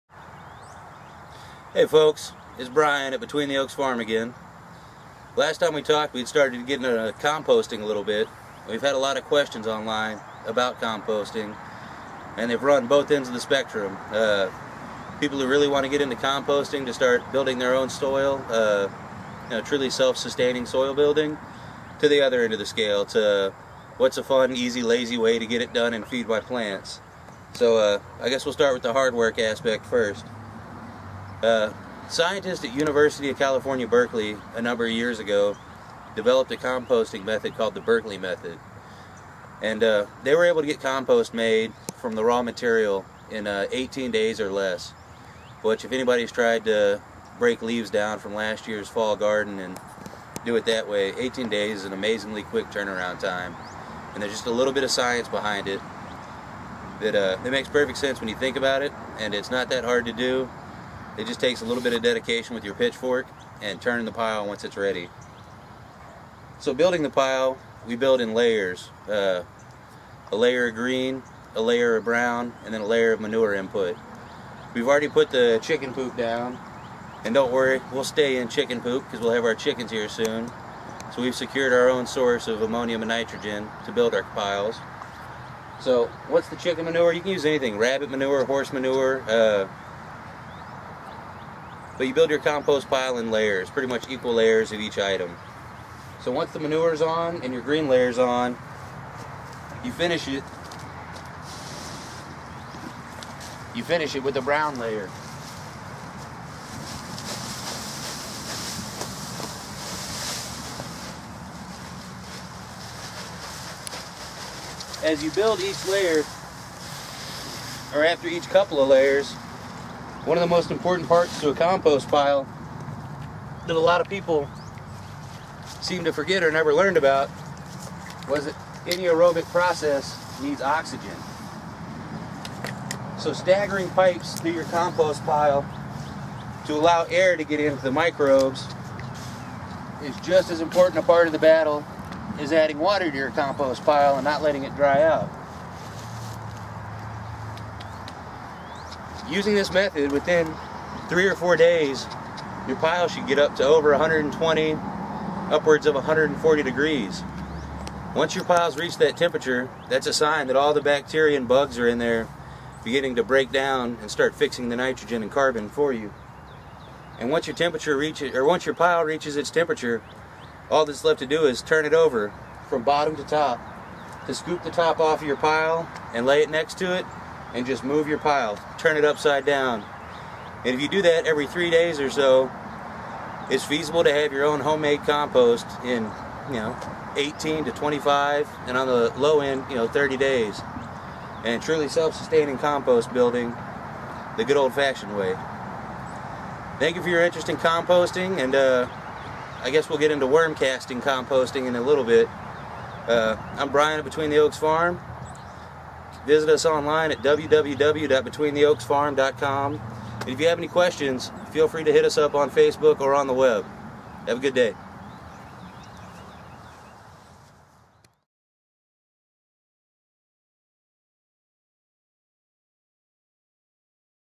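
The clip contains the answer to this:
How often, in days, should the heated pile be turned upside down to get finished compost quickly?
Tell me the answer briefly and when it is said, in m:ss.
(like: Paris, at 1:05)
Every 3 days, at 3:01.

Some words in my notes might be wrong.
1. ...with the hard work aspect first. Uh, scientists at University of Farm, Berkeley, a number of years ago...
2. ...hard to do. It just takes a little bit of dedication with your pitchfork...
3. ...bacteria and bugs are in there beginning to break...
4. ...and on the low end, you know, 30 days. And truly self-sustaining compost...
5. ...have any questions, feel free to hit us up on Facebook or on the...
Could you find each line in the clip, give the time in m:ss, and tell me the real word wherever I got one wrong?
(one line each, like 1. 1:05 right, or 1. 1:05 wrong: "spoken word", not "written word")
1. 0:28 wrong: "California", not "Farm"
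2. 0:59 right
3. 2:40 right
4. 3:08 right
5. 3:30 right.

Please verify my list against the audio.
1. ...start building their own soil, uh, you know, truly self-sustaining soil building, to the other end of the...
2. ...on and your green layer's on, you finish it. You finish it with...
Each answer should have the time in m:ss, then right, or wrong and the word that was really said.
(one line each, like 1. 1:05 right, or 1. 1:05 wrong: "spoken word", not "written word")
1. 0:16 right
2. 1:36 right.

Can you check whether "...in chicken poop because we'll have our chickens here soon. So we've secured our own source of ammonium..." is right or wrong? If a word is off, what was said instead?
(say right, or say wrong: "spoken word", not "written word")
right.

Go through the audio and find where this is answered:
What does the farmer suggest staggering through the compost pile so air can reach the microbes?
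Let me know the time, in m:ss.
2:13.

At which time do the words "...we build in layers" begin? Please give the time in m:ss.
1:07.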